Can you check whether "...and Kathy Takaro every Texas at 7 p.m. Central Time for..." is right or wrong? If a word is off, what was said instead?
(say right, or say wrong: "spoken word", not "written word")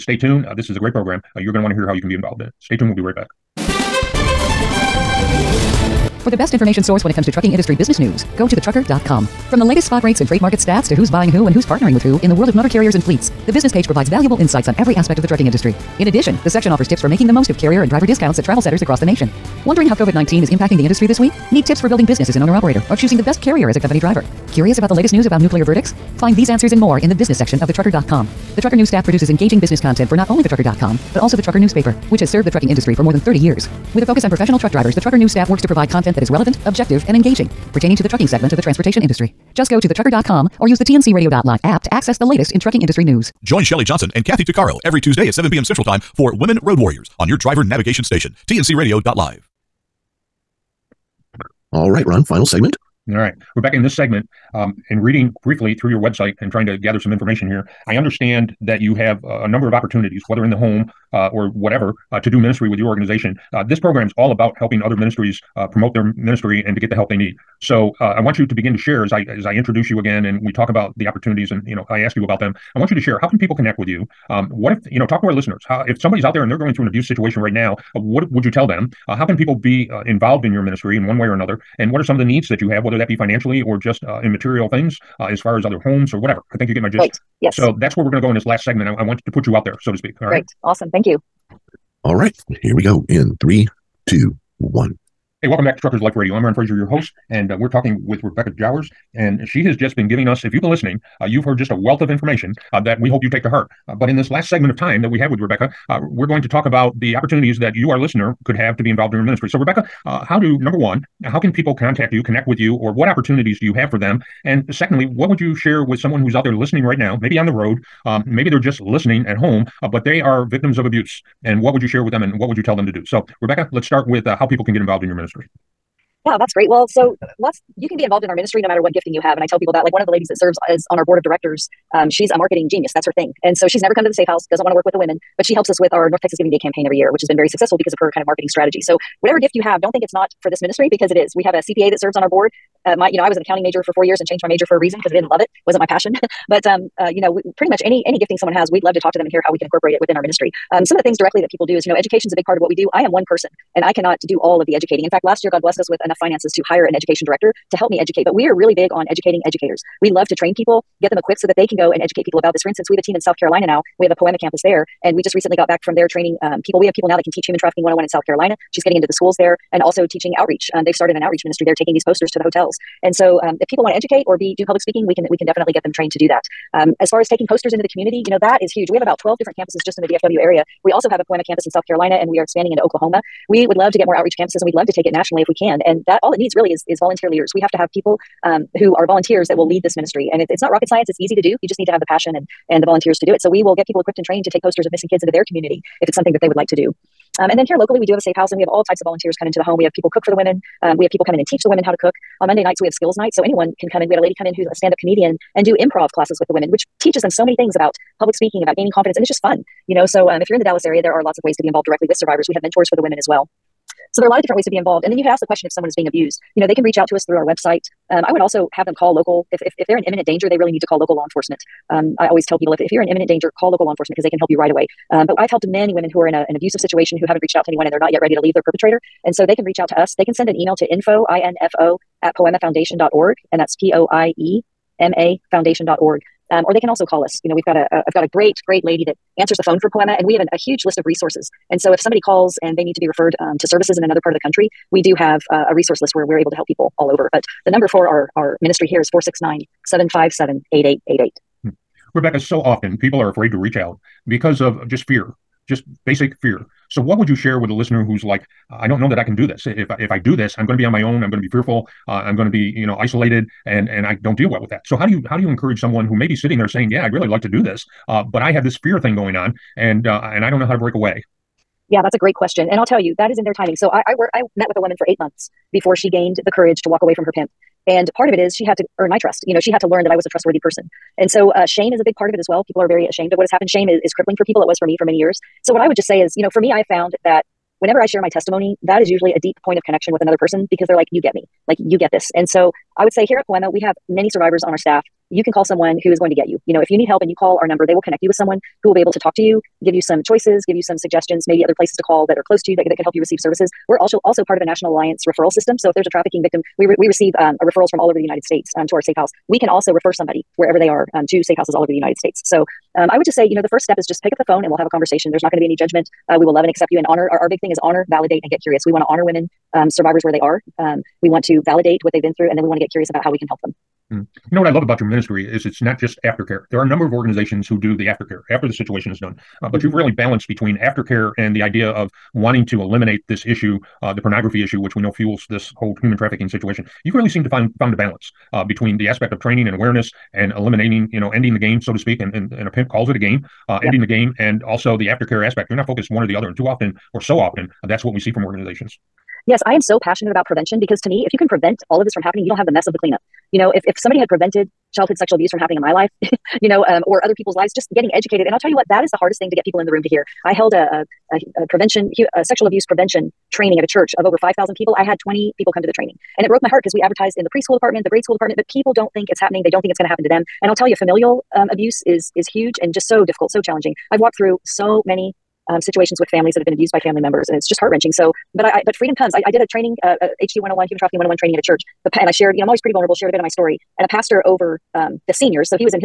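wrong: "Tuesday", not "Texas".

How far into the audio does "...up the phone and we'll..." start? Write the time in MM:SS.
05:14.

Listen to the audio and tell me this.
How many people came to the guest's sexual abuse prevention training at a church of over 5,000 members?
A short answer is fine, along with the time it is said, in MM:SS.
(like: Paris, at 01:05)
20, at 06:05.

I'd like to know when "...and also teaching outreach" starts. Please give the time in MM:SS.
02:49.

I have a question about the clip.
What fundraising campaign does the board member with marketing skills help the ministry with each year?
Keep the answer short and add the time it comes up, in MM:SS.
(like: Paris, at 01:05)
North Texas Giving Day, at 02:16.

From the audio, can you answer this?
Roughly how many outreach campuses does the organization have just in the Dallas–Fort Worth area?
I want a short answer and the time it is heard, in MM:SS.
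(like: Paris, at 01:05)
12, at 02:59.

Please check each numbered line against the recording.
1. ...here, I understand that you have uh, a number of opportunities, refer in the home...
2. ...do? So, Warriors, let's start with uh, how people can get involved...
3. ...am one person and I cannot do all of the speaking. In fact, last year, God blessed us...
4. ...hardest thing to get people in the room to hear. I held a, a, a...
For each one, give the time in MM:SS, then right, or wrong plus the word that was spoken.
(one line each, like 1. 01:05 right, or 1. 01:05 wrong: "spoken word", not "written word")
1. 00:57 wrong: "whether", not "refer"
2. 02:02 wrong: "Rebecca", not "Warriors"
3. 02:33 wrong: "educating", not "speaking"
4. 05:59 right.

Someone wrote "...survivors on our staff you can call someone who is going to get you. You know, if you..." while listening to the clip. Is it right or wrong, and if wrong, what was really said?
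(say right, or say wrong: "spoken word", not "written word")
right.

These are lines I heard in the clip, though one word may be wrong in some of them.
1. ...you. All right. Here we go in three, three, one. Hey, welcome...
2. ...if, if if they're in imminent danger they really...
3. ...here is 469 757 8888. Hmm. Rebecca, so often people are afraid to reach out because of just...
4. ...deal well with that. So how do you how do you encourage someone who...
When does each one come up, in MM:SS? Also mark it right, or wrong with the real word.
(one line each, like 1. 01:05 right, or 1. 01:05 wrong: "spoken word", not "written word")
1. 01:31 wrong: "two", not "three"
2. 03:39 right
3. 04:08 right
4. 04:24 right.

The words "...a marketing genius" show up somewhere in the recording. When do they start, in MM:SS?
02:12.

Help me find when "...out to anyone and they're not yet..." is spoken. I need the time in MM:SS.
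03:47.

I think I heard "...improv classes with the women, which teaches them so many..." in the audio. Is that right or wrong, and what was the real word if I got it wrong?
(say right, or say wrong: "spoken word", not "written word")
right.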